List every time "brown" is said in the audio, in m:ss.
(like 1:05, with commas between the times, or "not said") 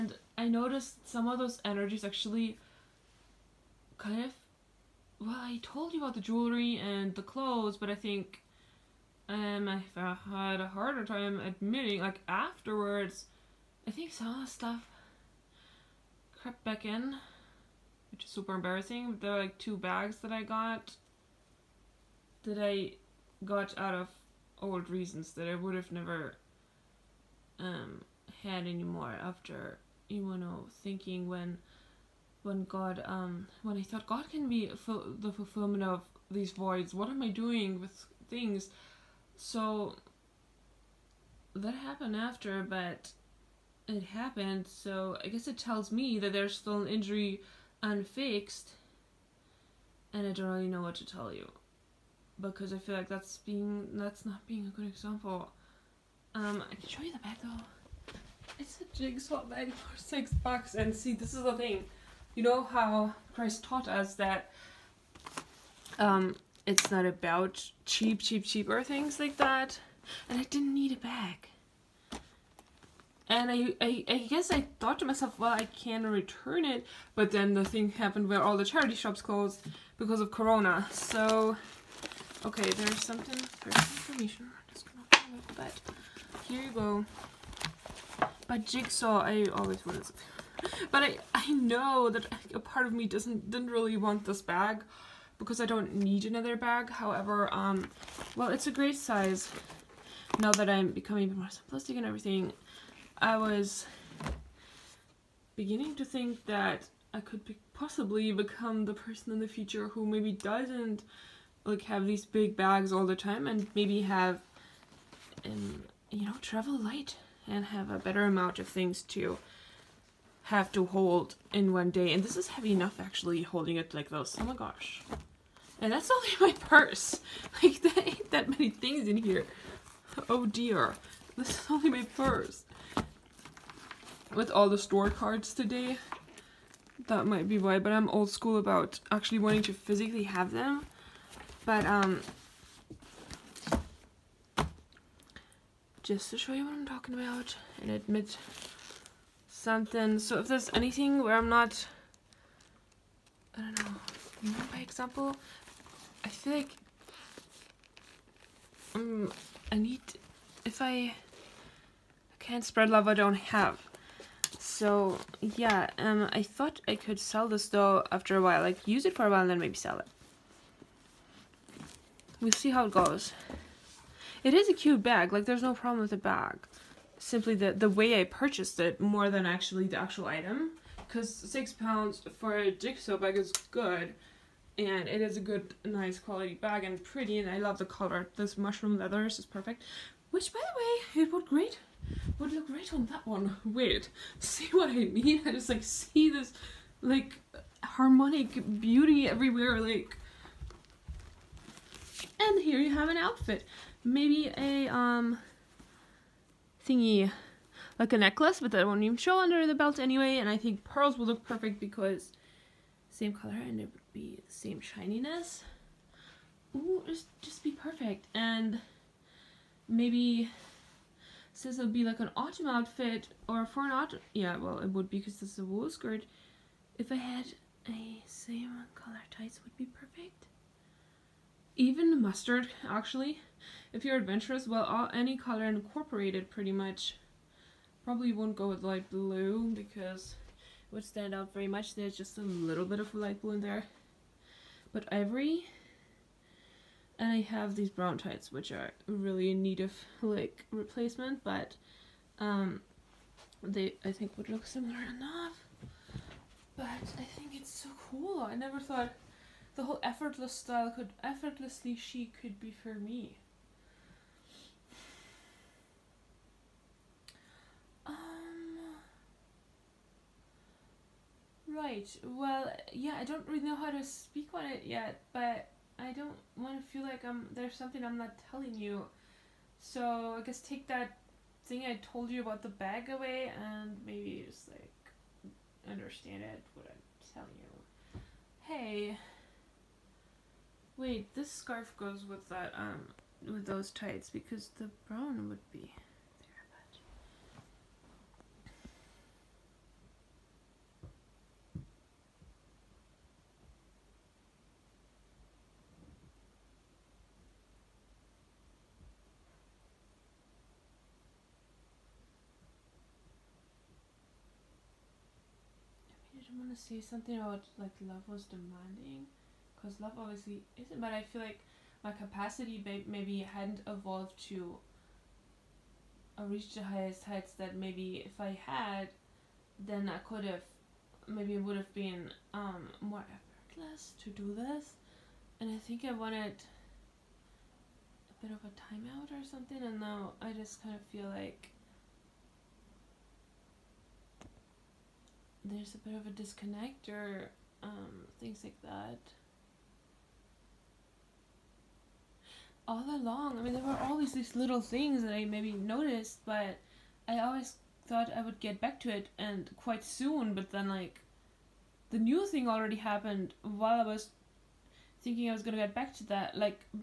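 4:07, 4:55.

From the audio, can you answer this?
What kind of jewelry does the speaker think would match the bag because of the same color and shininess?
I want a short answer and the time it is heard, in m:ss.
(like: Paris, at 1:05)
Pearls, at 3:30.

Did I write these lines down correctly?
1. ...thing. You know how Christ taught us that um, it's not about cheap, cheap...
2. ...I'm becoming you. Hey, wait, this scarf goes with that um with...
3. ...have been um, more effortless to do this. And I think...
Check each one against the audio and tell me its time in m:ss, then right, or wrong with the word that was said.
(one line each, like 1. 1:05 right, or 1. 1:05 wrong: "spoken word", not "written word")
1. 1:01 right
2. 4:46 wrong: "telling", not "becoming"
3. 5:31 right.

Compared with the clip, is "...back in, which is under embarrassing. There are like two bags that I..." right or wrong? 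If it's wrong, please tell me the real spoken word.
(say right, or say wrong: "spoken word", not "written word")
wrong: "super", not "under".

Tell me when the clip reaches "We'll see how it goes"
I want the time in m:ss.
2:52.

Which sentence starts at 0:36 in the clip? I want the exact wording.
What am I doing with things?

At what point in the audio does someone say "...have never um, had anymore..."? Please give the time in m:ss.
0:25.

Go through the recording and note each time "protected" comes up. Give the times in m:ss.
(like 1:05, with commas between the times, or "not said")
not said.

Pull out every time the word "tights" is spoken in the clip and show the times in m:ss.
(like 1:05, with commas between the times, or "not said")
3:49, 4:08, 4:53.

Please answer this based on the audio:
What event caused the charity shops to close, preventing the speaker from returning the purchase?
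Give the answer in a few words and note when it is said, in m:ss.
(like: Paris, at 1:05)
Corona, at 1:20.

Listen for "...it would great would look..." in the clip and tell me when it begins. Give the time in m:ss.
3:11.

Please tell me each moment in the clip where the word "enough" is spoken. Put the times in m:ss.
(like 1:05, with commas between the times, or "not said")
2:02, 4:14.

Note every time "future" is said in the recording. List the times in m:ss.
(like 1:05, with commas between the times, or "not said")
1:49.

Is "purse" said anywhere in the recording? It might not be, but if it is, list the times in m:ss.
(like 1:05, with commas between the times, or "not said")
2:06, 2:12.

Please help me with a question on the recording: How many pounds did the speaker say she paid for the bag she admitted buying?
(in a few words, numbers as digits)
6.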